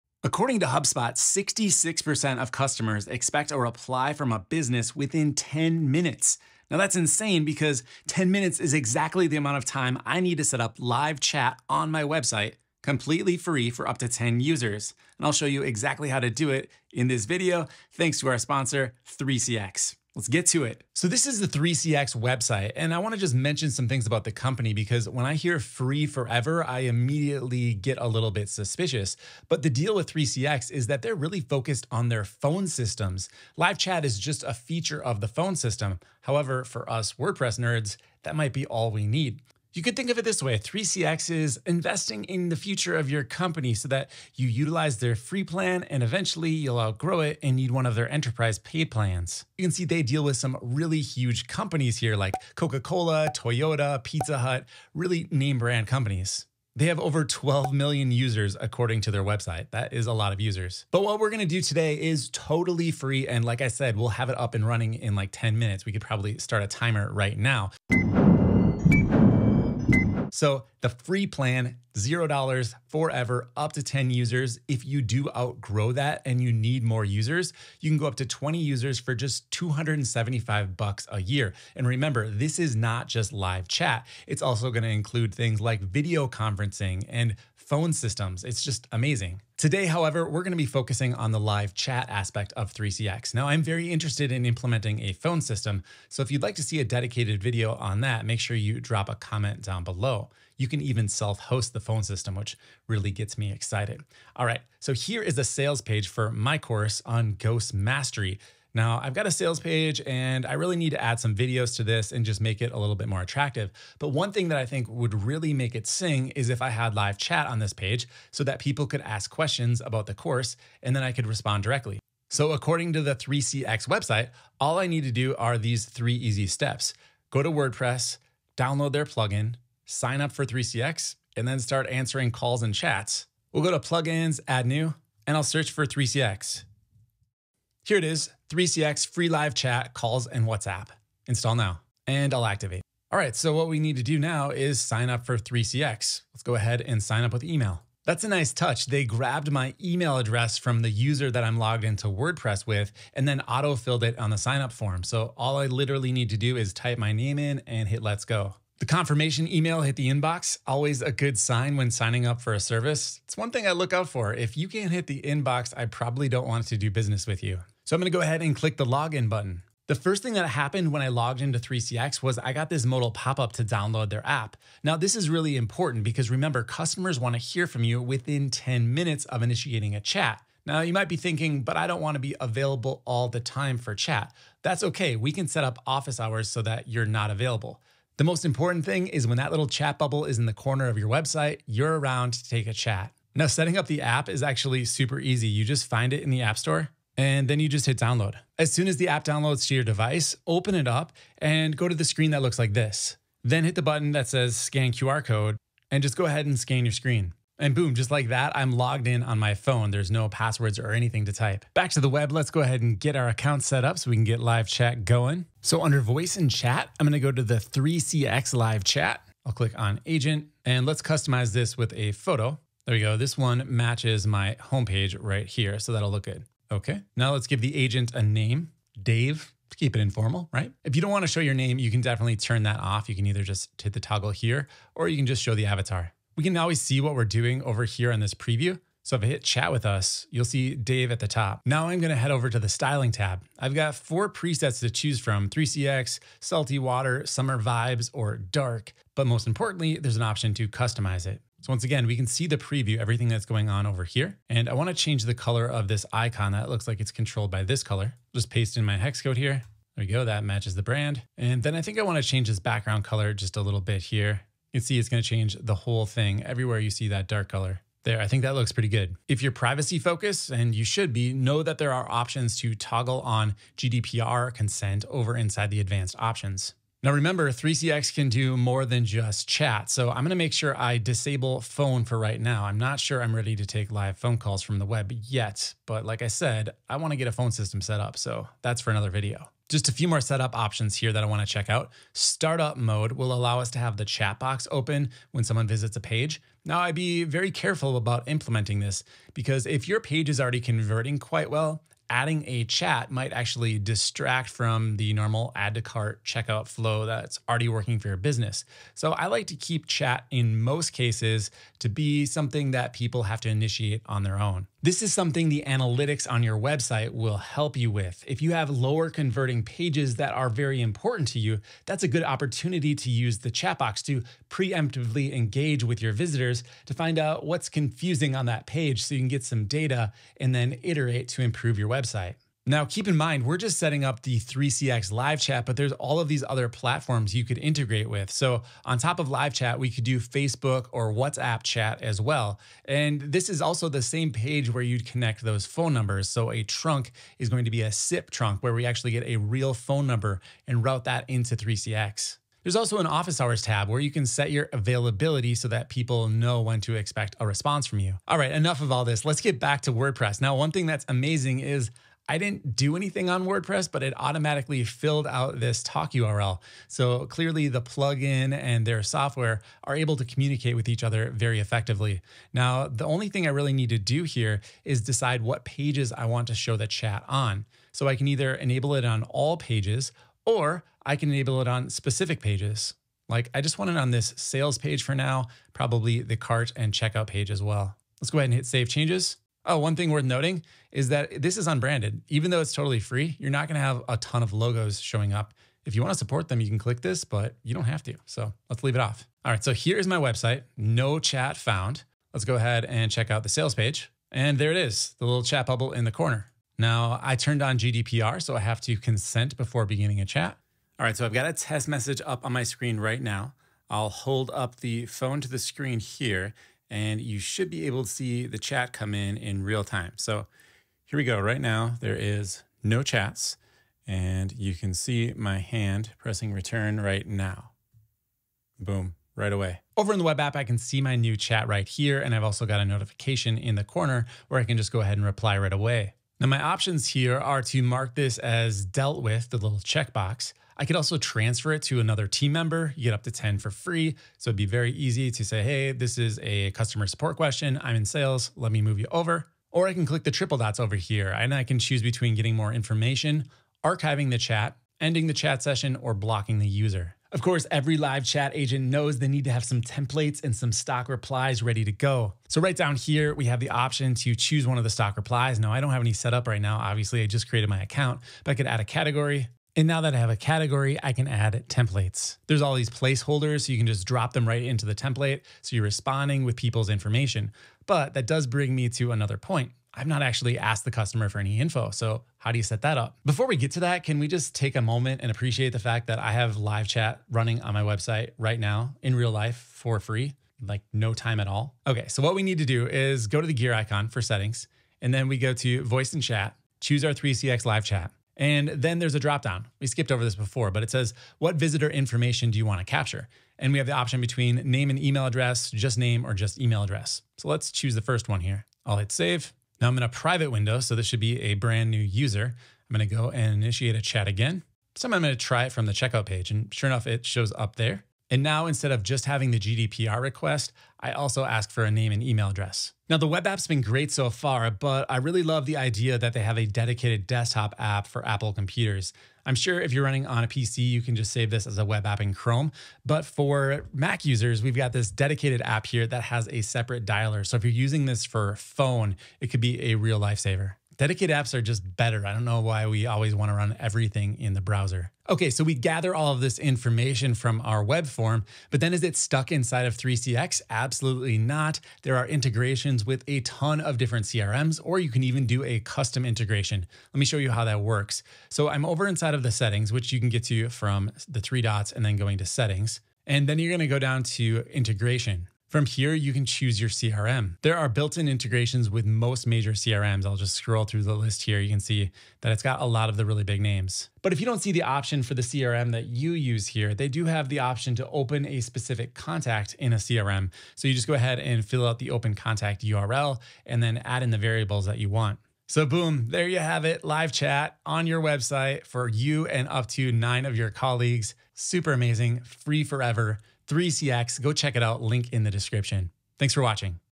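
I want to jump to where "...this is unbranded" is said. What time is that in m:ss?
6:31.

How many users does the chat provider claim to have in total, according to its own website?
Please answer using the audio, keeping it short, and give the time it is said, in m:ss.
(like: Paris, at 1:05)
12 million, at 0:57.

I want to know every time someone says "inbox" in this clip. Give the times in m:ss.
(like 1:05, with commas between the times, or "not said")
2:40, 2:45.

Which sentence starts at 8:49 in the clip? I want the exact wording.
I'm sure if you're running on a PC, you can just save this as a web app in Chrome.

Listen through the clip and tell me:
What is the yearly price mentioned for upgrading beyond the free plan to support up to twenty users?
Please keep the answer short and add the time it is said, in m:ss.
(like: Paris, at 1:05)
$275, at 1:19.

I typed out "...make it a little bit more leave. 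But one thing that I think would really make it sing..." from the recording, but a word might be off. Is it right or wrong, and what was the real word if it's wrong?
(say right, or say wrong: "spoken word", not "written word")
wrong: "attractive", not "leave".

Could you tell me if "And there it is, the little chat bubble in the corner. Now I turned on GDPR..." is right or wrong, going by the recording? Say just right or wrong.
right.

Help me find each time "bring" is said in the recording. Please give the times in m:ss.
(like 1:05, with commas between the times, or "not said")
7:58.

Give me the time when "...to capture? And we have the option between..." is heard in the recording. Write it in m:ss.
8:22.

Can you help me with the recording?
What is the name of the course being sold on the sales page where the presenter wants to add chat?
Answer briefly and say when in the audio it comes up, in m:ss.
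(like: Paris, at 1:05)
Ghost Mastery, at 1:47.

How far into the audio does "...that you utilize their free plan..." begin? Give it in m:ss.
0:43.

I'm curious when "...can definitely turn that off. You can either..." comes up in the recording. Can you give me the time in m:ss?
3:51.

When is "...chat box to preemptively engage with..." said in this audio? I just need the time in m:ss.
5:23.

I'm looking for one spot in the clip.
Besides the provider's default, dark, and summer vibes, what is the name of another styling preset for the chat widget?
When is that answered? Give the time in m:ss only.
4:06.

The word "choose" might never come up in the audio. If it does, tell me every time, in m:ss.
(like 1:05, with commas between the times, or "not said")
4:04, 7:31, 7:44, 8:16, 8:27, 9:26.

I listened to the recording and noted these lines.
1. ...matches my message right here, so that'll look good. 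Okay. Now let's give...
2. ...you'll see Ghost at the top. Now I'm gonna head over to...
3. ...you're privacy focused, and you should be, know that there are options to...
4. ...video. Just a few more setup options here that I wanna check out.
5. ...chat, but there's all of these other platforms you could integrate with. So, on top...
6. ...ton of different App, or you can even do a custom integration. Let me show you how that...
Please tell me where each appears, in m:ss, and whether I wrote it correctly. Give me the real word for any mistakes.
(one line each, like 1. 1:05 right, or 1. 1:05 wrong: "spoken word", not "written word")
1. 3:43 wrong: "homepage", not "message"
2. 4:00 wrong: "Dave", not "Ghost"
3. 4:29 right
4. 4:49 right
5. 5:35 right
6. 9:13 wrong: "CRMs", not "App".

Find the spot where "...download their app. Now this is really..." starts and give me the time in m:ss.
2:53.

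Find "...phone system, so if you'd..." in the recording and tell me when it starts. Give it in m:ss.
1:35.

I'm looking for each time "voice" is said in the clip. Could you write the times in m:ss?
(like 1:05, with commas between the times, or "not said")
3:36, 8:15.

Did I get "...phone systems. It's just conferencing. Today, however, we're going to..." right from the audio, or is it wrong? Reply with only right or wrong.
wrong.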